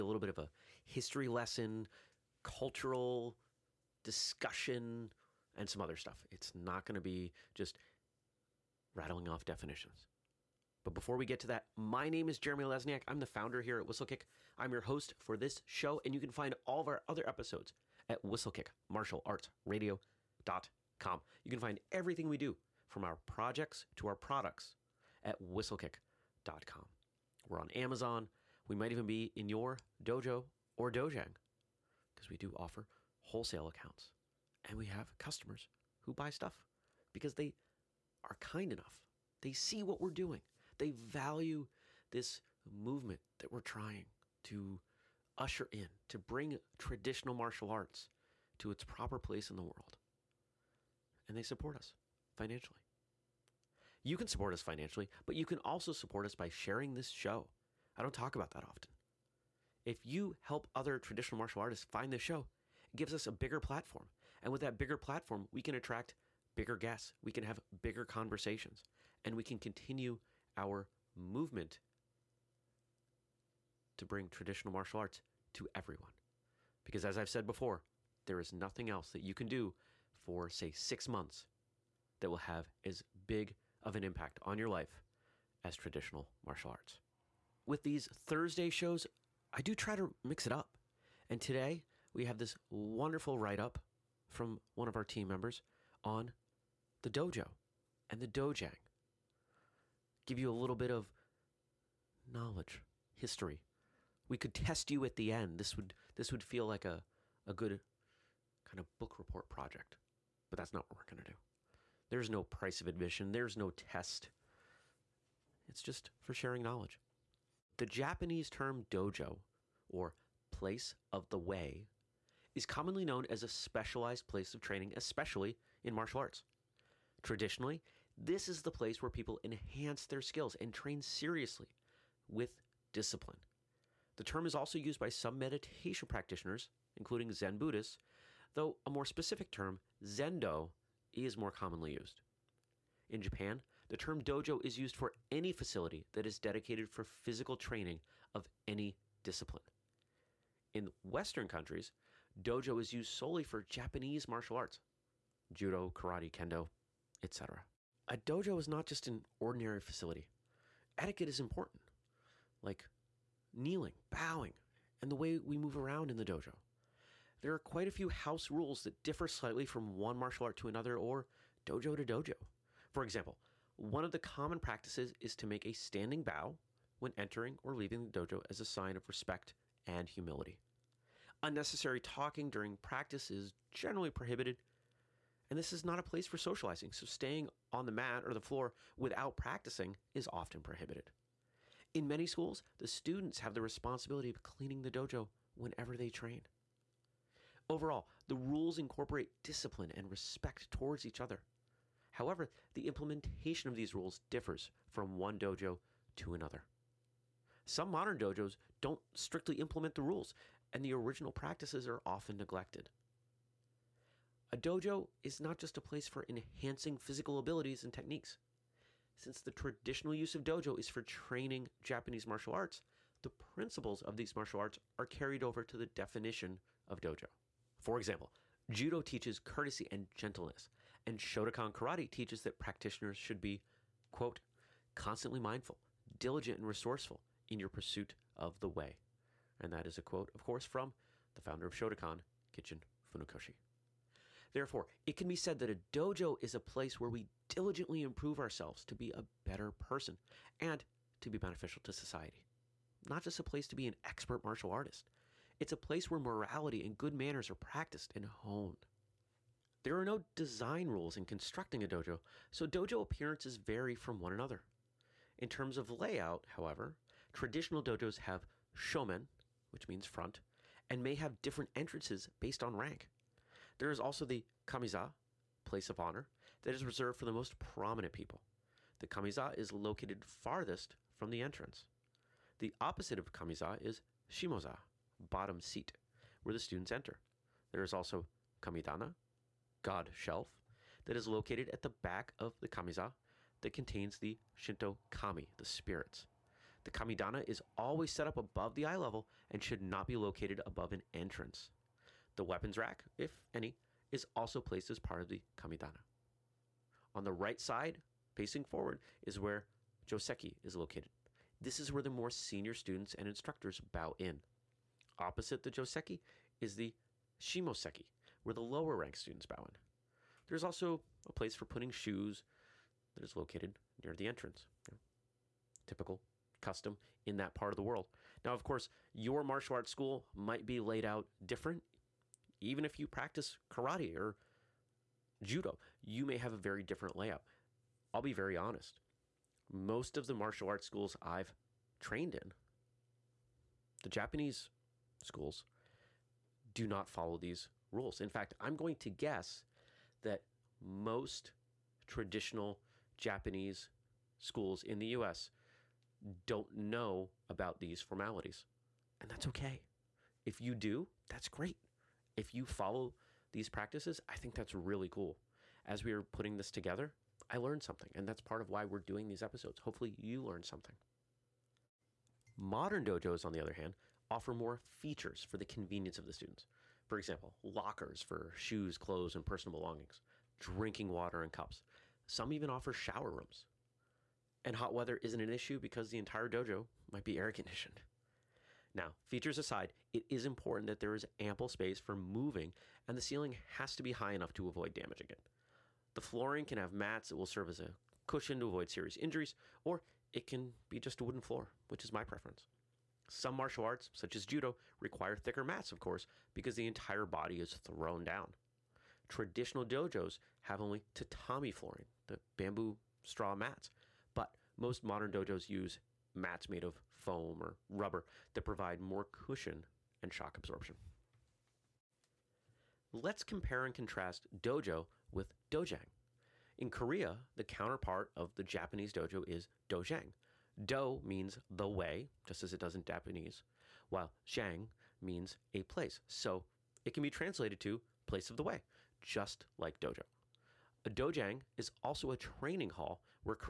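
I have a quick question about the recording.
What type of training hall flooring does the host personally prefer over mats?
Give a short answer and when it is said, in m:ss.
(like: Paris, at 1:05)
wooden floor, at 6:41.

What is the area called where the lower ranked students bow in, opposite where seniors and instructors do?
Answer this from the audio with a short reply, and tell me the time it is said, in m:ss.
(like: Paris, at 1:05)
shimoseki, at 5:17.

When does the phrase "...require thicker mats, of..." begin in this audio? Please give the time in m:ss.
6:44.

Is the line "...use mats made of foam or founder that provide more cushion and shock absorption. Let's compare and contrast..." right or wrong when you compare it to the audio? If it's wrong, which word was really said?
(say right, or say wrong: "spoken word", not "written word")
wrong: "rubber", not "founder".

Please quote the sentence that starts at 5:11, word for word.
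This is where the more senior students and instructors bow in.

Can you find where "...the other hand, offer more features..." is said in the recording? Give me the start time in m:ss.
6:13.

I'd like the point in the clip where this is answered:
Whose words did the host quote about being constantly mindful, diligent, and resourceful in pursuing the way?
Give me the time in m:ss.
4:02.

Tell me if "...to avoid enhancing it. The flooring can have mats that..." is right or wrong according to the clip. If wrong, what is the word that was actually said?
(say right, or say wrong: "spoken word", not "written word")
wrong: "damaging", not "enhancing".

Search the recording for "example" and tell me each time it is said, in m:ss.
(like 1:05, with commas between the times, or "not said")
2:53, 3:47, 6:17.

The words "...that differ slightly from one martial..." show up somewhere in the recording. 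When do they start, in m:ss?
2:48.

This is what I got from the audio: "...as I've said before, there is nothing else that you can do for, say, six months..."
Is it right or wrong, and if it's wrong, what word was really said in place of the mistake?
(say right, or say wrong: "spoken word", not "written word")
right.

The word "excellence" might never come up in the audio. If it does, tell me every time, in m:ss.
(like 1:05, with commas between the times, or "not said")
not said.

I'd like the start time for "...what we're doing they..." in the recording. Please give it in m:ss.
0:39.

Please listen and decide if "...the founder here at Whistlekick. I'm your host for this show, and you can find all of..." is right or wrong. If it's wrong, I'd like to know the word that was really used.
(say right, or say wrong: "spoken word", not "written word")
right.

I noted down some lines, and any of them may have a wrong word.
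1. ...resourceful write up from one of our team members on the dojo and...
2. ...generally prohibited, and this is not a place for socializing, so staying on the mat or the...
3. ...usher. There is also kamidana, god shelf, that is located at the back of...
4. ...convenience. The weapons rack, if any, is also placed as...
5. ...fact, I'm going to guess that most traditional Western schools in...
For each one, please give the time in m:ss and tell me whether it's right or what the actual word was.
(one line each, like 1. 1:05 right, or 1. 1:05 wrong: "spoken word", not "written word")
1. 1:32 wrong: "wonderful", not "resourceful"
2. 3:03 right
3. 4:46 wrong: "enter", not "usher"
4. 5:01 wrong: "entrance", not "convenience"
5. 5:48 wrong: "Japanese", not "Western".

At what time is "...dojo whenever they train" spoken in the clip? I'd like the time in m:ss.
3:14.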